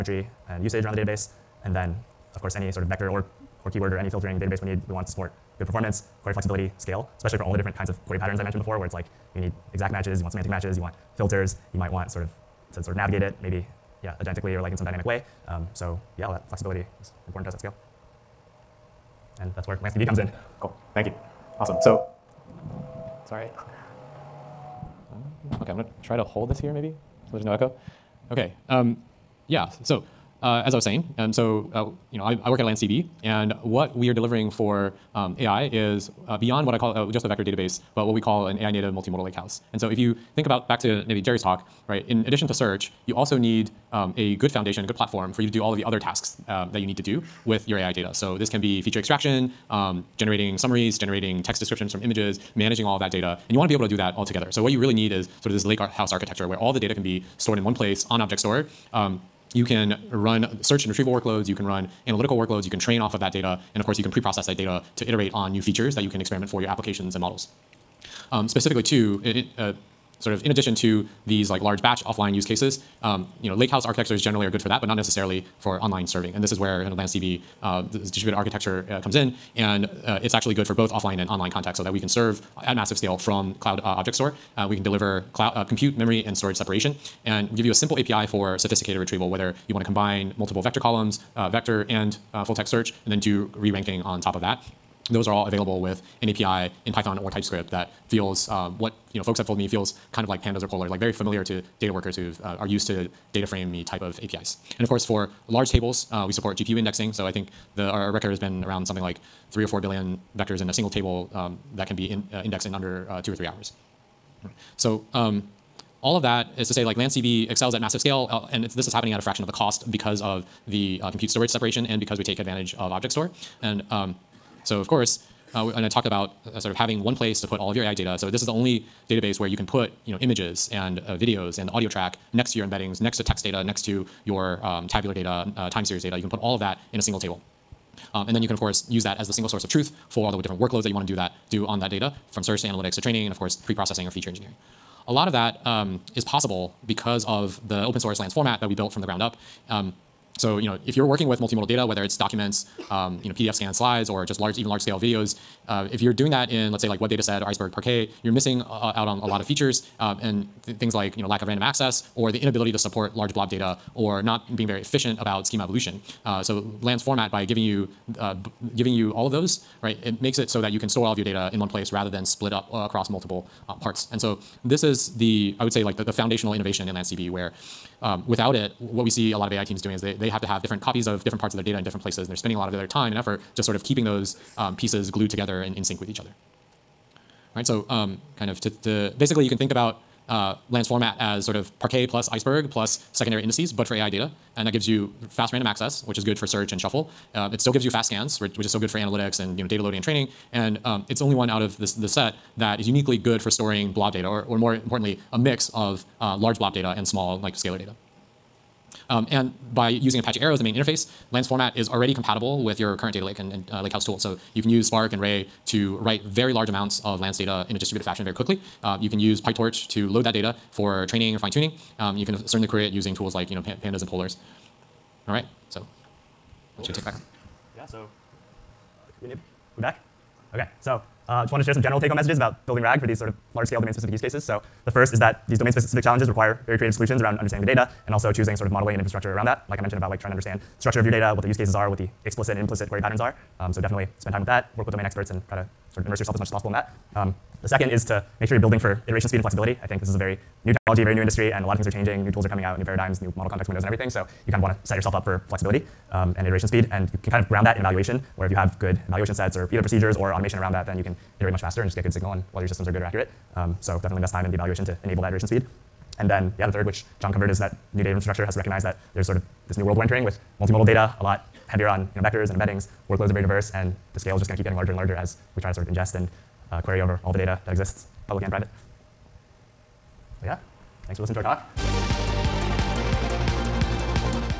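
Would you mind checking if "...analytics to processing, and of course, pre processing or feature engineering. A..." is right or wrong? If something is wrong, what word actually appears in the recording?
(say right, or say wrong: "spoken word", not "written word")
wrong: "training", not "processing".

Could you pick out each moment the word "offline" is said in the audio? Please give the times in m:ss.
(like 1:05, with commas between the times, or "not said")
1:12, 1:20.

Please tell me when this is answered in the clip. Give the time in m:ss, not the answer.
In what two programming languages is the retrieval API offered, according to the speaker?
1:36.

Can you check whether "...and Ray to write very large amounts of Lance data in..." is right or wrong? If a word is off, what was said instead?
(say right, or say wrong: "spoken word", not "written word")
right.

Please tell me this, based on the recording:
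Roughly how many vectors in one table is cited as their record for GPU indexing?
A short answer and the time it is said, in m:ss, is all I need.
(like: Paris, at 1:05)
3 or 4 billion, at 1:49.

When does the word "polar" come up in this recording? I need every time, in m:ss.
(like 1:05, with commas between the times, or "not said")
1:40, 3:44.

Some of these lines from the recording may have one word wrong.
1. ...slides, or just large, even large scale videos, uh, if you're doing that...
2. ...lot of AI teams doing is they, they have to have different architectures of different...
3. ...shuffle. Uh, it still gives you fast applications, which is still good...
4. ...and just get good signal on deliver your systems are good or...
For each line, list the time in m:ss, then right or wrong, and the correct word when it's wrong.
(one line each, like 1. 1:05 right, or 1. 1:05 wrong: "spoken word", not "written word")
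1. 2:33 right
2. 2:59 wrong: "copies", not "architectures"
3. 3:16 wrong: "scans", not "applications"
4. 4:21 wrong: "whether", not "deliver".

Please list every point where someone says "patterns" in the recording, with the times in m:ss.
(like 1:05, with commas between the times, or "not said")
0:08, 4:03.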